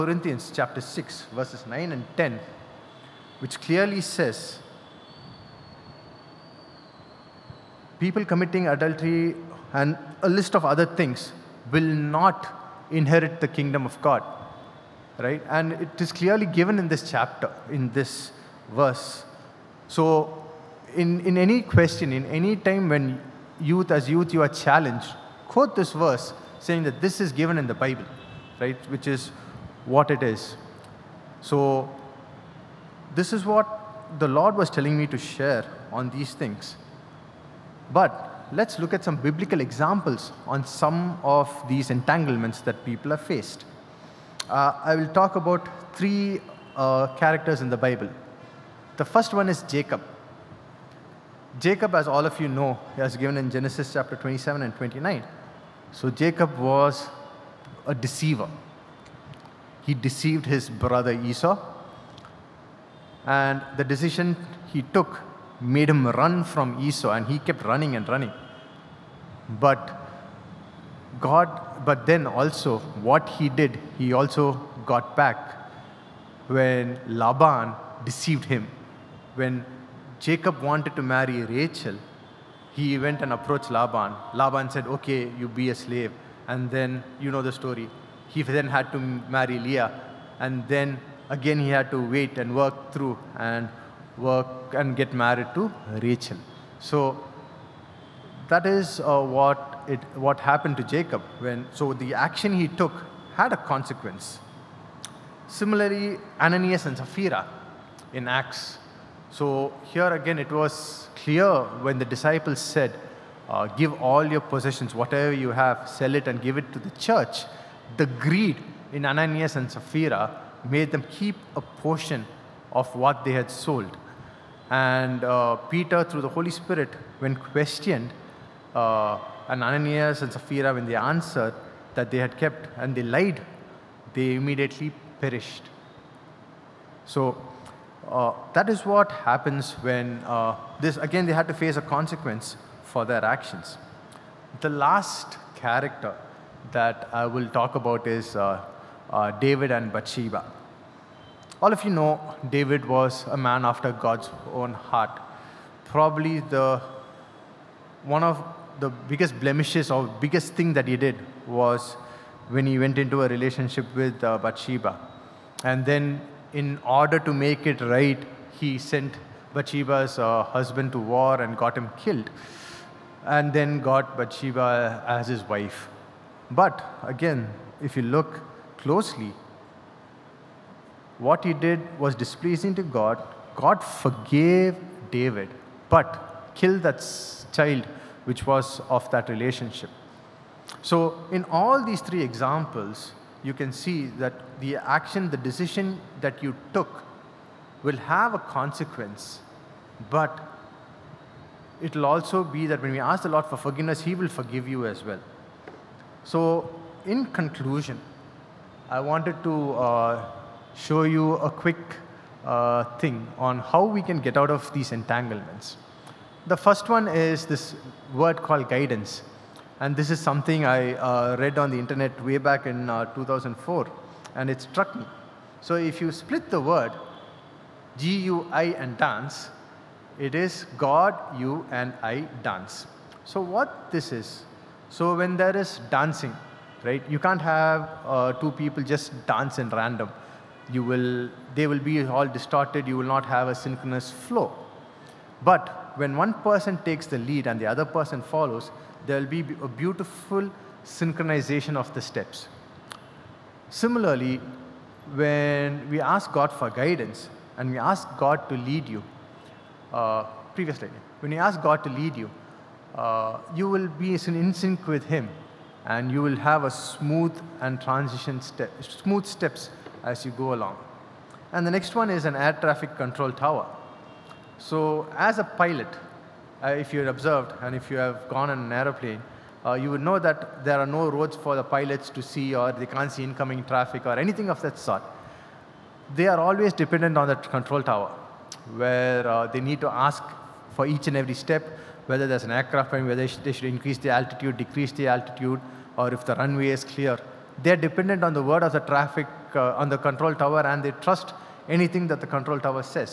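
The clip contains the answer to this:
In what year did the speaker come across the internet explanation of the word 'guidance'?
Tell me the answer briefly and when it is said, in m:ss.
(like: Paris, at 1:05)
2004, at 3:43.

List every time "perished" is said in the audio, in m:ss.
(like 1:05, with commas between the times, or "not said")
2:15.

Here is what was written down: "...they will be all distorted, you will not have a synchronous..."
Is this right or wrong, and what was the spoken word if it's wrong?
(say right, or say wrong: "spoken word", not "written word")
right.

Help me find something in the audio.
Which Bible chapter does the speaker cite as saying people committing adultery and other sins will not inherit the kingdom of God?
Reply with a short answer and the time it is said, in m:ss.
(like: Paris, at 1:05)
Chapter 6, at 0:00.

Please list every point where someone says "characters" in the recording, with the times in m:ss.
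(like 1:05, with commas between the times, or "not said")
0:47, 2:25.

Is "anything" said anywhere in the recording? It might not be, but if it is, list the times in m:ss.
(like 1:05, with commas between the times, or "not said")
4:44, 5:01.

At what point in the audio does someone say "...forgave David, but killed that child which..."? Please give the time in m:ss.
3:03.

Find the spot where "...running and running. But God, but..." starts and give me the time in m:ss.
1:07.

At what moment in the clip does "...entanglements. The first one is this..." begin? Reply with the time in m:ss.
3:34.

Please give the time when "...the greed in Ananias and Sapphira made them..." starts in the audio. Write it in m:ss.
1:57.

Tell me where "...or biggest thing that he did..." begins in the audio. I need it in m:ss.
2:39.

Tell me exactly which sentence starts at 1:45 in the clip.
Similarly, Ananias and Sapphira in Acts.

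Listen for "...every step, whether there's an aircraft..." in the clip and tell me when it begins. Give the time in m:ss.
4:51.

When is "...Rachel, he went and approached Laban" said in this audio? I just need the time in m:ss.
1:21.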